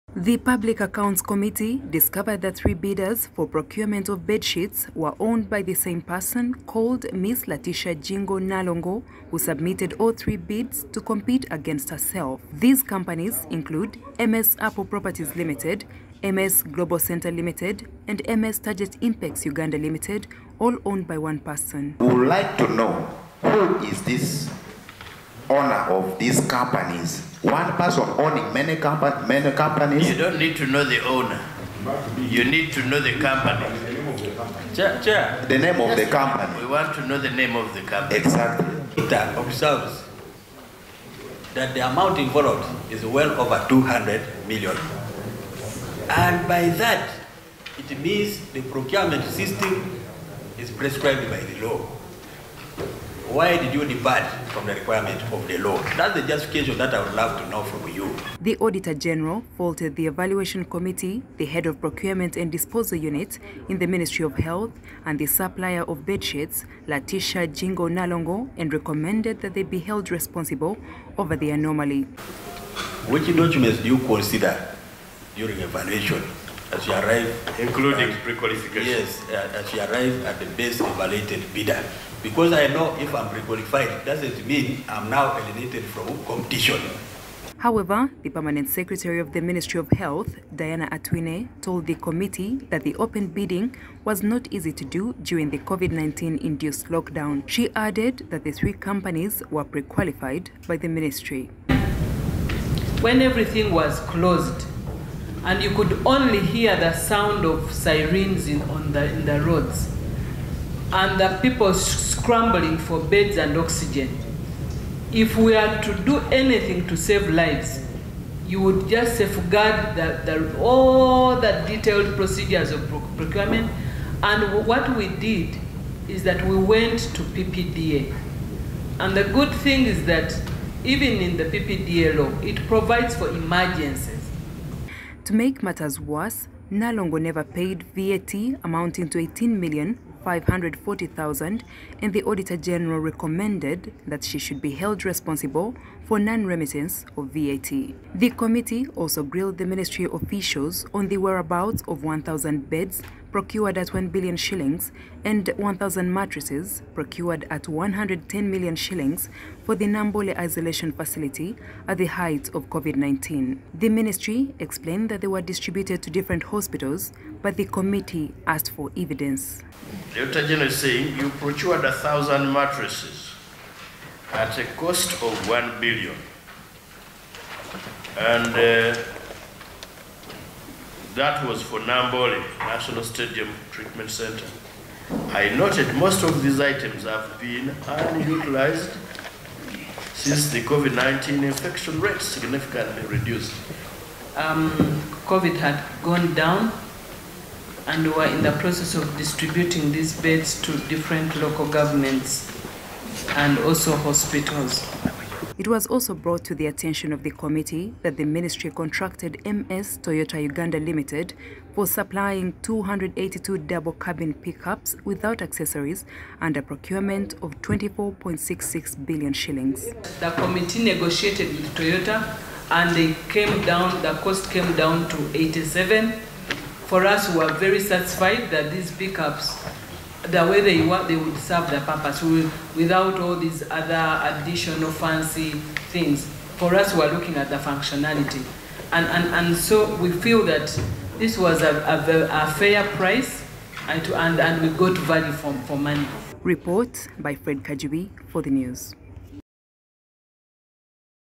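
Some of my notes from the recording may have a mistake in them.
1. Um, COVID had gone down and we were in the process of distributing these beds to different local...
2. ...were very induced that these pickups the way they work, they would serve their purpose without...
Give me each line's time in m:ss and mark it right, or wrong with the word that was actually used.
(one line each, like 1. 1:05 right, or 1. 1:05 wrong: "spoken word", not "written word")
1. 3:14 right
2. 3:47 wrong: "satisfied", not "induced".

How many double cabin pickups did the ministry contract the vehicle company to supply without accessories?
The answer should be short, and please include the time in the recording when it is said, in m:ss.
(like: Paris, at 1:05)
282, at 3:32.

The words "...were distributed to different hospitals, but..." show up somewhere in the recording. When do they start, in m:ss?
2:45.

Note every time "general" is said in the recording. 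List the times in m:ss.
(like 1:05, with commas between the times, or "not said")
0:58, 2:22, 2:50.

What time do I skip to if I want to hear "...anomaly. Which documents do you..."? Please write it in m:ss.
1:11.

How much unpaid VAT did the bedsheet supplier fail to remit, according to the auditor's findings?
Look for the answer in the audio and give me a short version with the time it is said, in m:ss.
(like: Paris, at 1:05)
18,540,000, at 2:19.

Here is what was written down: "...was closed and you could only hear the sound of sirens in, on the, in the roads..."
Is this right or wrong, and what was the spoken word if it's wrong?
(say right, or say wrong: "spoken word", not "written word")
right.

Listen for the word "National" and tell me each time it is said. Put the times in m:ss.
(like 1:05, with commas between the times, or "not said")
3:02.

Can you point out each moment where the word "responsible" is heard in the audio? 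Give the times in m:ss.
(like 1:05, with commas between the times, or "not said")
1:10, 2:25.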